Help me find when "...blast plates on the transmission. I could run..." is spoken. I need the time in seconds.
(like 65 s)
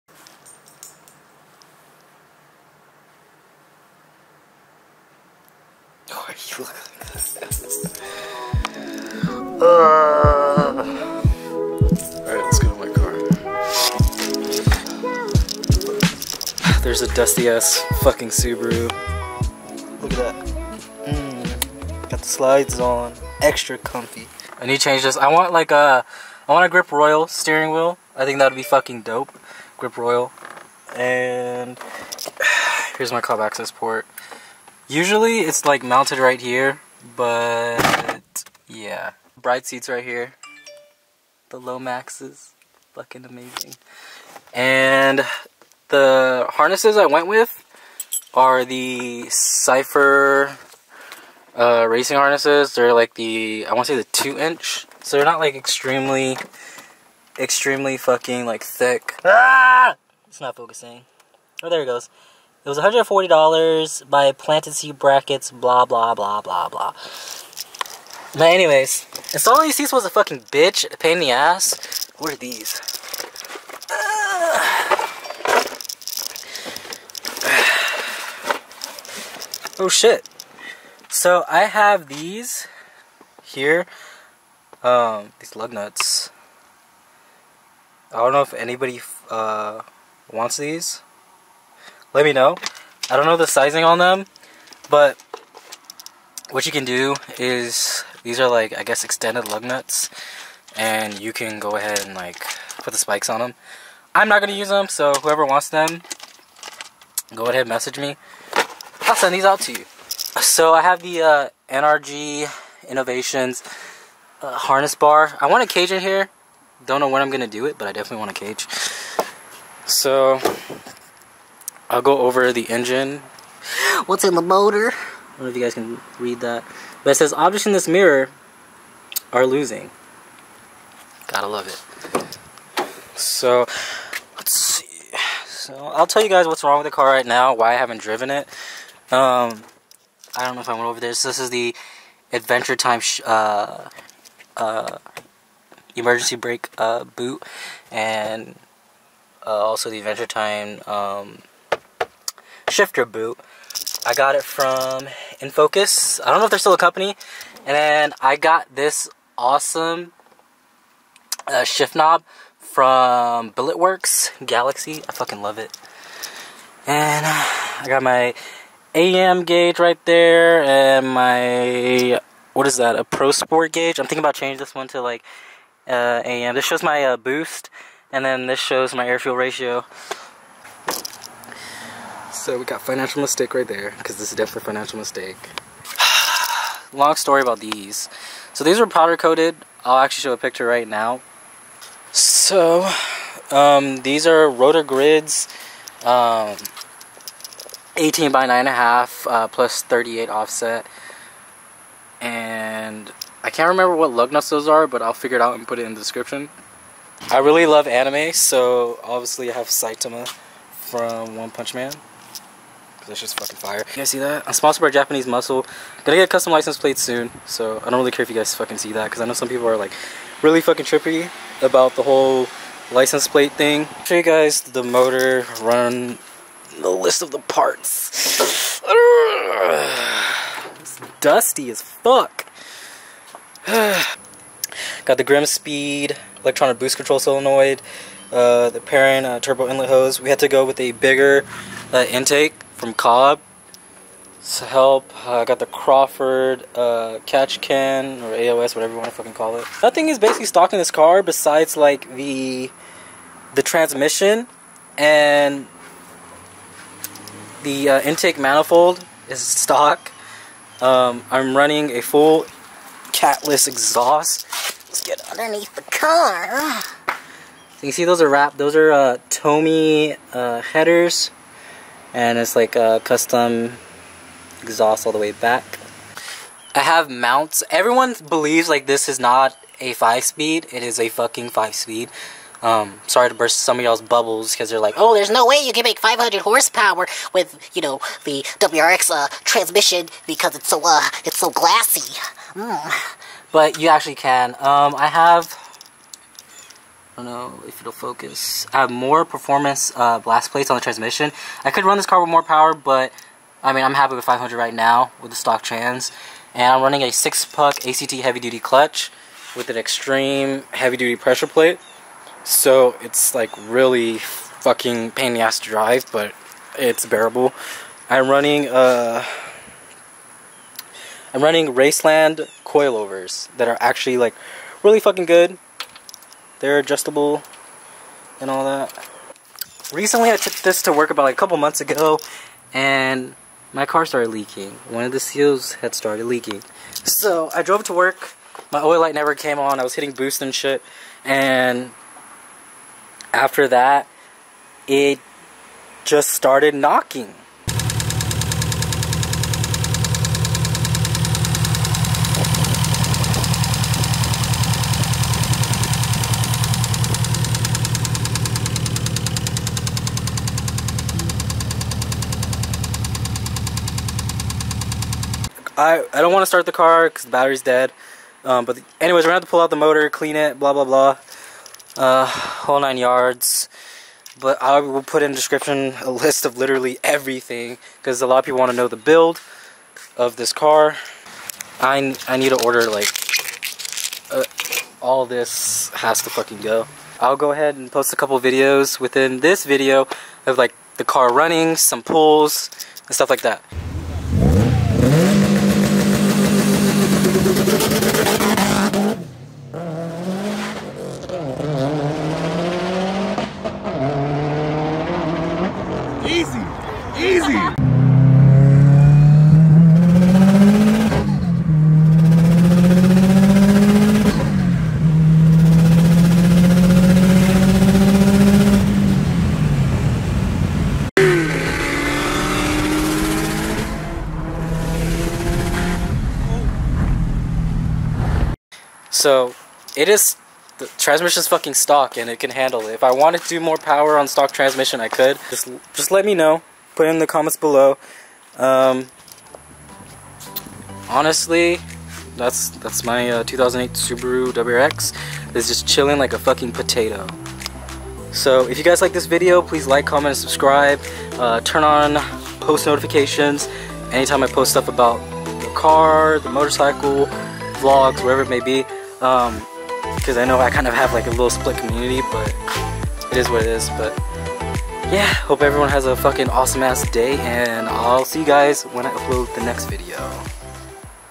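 300 s.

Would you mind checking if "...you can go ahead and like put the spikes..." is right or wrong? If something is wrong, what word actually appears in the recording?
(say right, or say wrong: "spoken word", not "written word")
right.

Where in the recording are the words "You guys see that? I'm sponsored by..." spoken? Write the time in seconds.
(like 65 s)
213 s.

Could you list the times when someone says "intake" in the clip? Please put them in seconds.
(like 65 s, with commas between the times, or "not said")
242 s, 258 s.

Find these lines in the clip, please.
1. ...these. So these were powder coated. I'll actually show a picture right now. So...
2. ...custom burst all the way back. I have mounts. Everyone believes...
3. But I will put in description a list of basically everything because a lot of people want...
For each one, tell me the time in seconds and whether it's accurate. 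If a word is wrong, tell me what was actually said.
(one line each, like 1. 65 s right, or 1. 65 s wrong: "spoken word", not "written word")
1. 187 s right
2. 273 s wrong: "exhaust", not "burst"
3. 374 s wrong: "literally", not "basically".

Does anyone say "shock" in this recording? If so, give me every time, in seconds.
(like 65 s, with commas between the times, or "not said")
not said.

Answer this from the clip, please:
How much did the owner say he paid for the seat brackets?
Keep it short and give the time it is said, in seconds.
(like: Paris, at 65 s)
$140, at 62 s.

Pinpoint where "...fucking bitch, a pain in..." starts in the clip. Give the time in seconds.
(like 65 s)
70 s.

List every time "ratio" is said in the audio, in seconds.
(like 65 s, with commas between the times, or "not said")
179 s.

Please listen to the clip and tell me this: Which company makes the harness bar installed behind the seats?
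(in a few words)
NRG Innovations.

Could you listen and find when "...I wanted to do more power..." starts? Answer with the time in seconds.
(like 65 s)
433 s.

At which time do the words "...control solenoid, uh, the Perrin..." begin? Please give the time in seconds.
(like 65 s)
236 s.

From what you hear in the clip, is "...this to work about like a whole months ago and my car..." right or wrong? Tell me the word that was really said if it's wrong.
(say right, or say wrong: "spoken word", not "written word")
wrong: "couple", not "whole".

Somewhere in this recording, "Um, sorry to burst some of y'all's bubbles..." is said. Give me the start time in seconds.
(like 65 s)
282 s.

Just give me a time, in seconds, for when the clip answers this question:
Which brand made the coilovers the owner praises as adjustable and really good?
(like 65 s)
321 s.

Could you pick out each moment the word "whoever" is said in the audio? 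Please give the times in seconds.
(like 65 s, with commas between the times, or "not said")
105 s.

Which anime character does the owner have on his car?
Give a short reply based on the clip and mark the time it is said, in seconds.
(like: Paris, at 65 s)
Saitama, at 209 s.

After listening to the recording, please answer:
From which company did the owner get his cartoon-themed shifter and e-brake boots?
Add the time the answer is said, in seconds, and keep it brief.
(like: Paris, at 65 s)
InFocus, at 155 s.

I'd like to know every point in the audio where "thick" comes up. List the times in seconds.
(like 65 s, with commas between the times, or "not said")
58 s.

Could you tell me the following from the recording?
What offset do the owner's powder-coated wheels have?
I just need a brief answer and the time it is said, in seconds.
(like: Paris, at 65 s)
+38, at 199 s.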